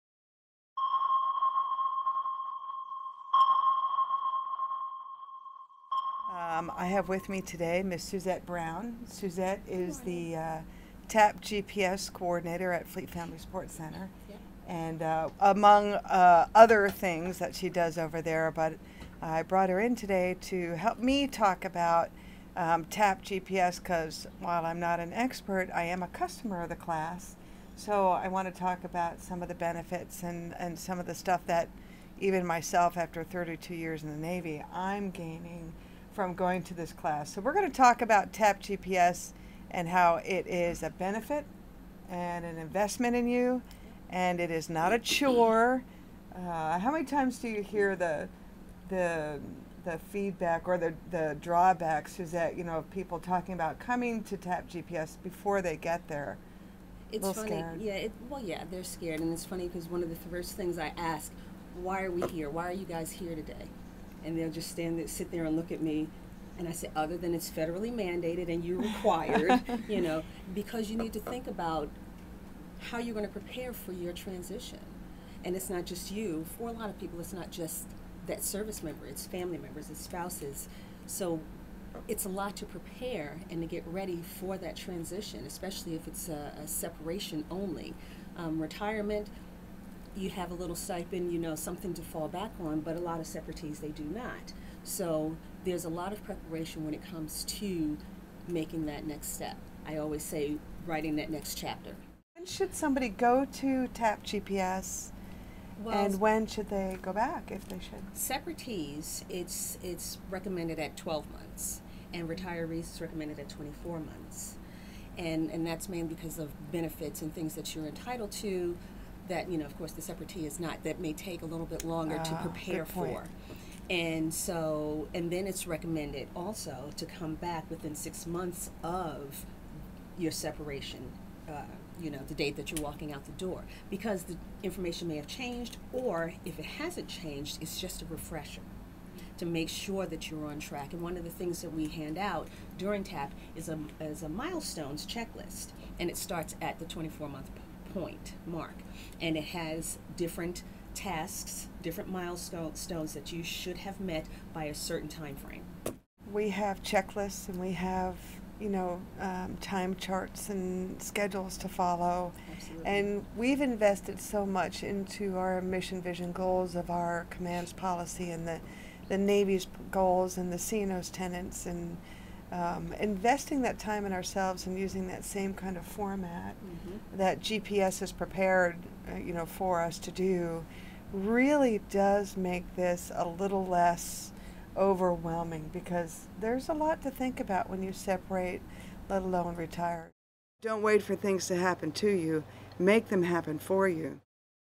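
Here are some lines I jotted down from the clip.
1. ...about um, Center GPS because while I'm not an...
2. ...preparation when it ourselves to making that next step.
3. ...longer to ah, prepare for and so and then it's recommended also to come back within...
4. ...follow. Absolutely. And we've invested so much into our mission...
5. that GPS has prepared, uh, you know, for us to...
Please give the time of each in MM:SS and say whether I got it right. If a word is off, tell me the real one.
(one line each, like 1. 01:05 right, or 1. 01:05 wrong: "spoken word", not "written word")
1. 00:21 wrong: "TAP", not "Center"
2. 01:36 wrong: "comes", not "ourselves"
3. 02:01 right
4. 02:41 right
5. 02:57 right.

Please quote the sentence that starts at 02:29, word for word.
And it has different tasks, different milestones that you should have met by a certain time frame.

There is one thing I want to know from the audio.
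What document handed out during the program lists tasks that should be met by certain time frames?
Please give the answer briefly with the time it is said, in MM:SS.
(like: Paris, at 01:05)
milestones checklist, at 02:24.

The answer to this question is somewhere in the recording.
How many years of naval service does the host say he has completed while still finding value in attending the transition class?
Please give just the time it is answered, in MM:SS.
00:33.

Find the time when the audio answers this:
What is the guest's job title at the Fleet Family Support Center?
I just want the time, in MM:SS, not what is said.
00:11.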